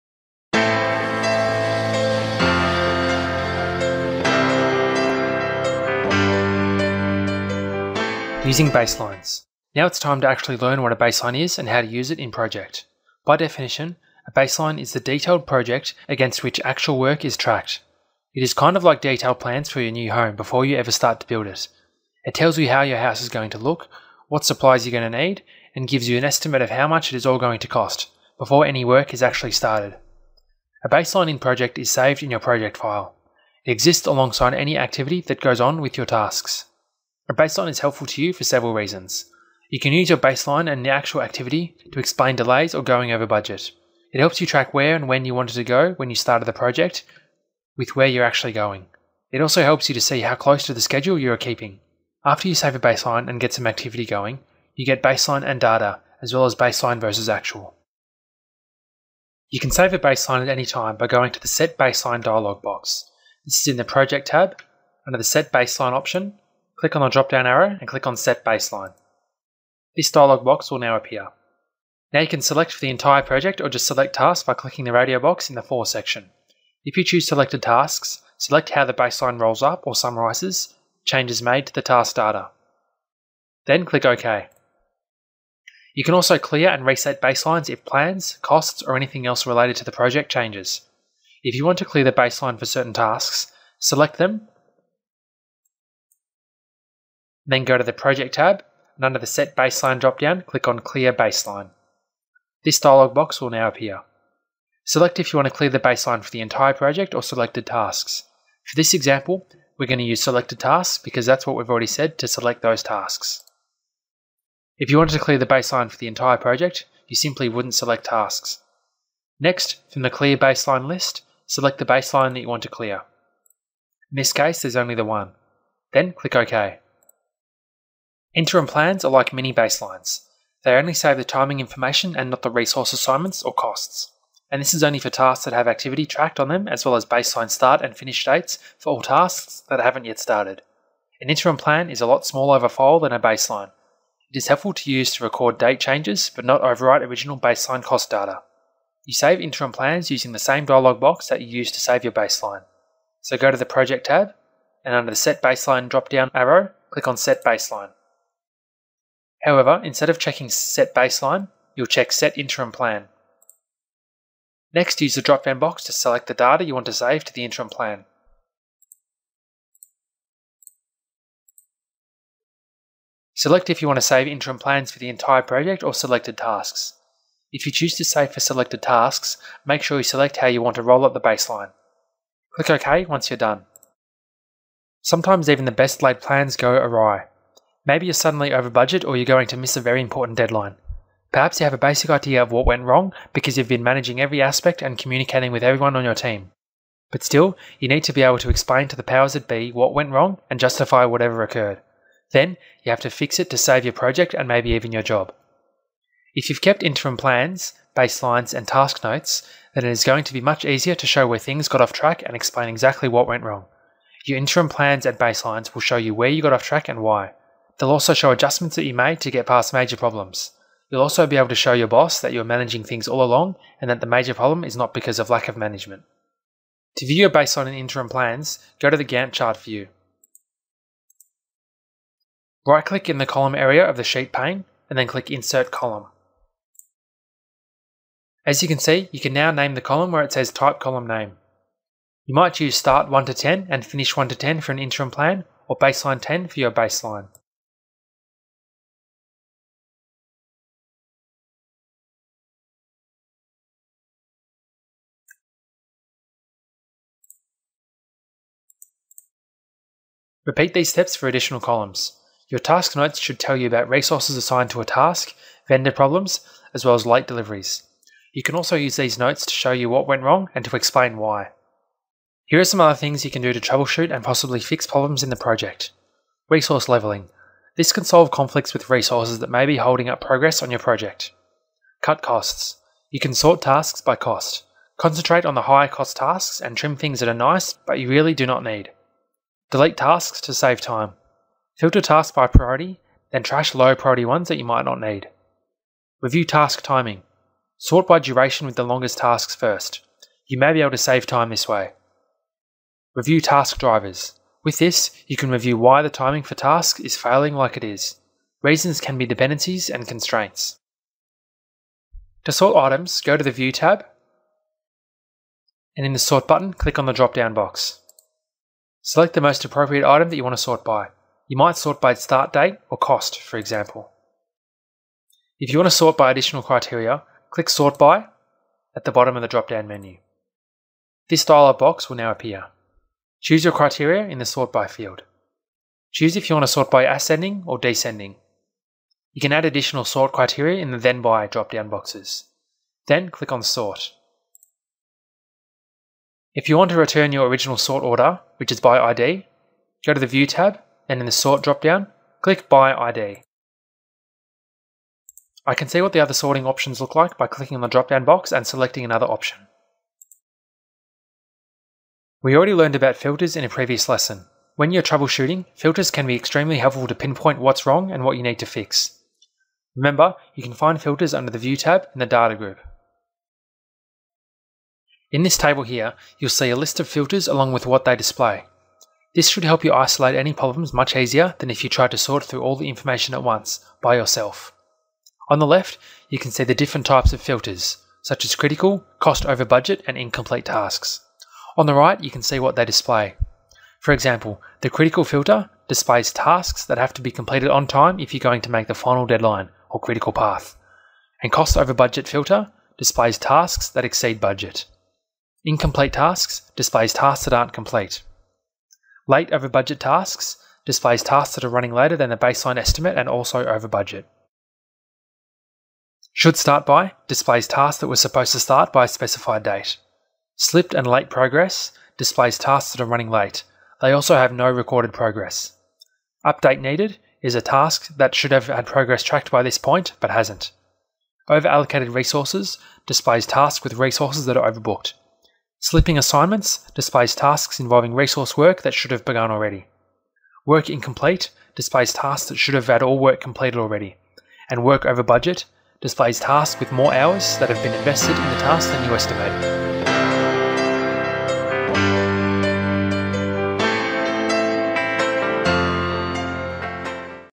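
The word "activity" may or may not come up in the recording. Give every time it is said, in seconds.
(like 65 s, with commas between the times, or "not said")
34 s, 41 s, 53 s, 135 s.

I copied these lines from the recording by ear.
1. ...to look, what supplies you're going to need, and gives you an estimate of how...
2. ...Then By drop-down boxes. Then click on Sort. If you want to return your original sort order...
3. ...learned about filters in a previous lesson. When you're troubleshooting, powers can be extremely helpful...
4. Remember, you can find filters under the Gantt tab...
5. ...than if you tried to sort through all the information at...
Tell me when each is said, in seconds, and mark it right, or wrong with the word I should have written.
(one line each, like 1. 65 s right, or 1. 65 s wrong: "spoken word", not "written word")
1. 23 s right
2. 340 s right
3. 362 s wrong: "filters", not "powers"
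4. 369 s wrong: "View", not "Gantt"
5. 381 s right.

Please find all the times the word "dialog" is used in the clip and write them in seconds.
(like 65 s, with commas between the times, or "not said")
62 s, 70 s, 102 s, 150 s, 331 s.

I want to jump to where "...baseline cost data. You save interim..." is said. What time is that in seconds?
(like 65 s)
147 s.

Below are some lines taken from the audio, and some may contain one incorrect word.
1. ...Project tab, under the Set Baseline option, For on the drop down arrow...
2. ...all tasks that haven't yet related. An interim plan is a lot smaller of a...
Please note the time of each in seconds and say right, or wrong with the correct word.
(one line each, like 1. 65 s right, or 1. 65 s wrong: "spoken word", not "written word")
1. 63 s wrong: "Click", not "For"
2. 138 s wrong: "started", not "related".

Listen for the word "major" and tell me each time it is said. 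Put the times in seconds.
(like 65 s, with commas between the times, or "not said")
219 s, 224 s.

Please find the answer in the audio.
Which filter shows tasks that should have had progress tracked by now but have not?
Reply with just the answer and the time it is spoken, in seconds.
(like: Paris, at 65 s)
Update needed, at 426 s.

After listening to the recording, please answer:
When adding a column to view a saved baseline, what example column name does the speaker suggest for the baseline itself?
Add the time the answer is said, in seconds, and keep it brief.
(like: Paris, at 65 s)
baseline 10, at 245 s.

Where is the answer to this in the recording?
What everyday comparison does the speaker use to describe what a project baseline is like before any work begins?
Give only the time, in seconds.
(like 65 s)
18 s.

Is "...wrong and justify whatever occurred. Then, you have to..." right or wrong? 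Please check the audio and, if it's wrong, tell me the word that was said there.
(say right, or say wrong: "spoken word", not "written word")
right.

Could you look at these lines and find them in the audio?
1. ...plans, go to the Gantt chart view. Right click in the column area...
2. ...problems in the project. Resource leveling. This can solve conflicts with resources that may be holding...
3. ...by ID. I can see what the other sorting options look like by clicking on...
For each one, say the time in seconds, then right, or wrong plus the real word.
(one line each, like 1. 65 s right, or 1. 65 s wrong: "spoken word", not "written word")
1. 228 s right
2. 274 s right
3. 352 s right.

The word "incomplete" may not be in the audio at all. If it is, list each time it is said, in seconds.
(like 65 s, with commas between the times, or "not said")
390 s, 405 s, 440 s.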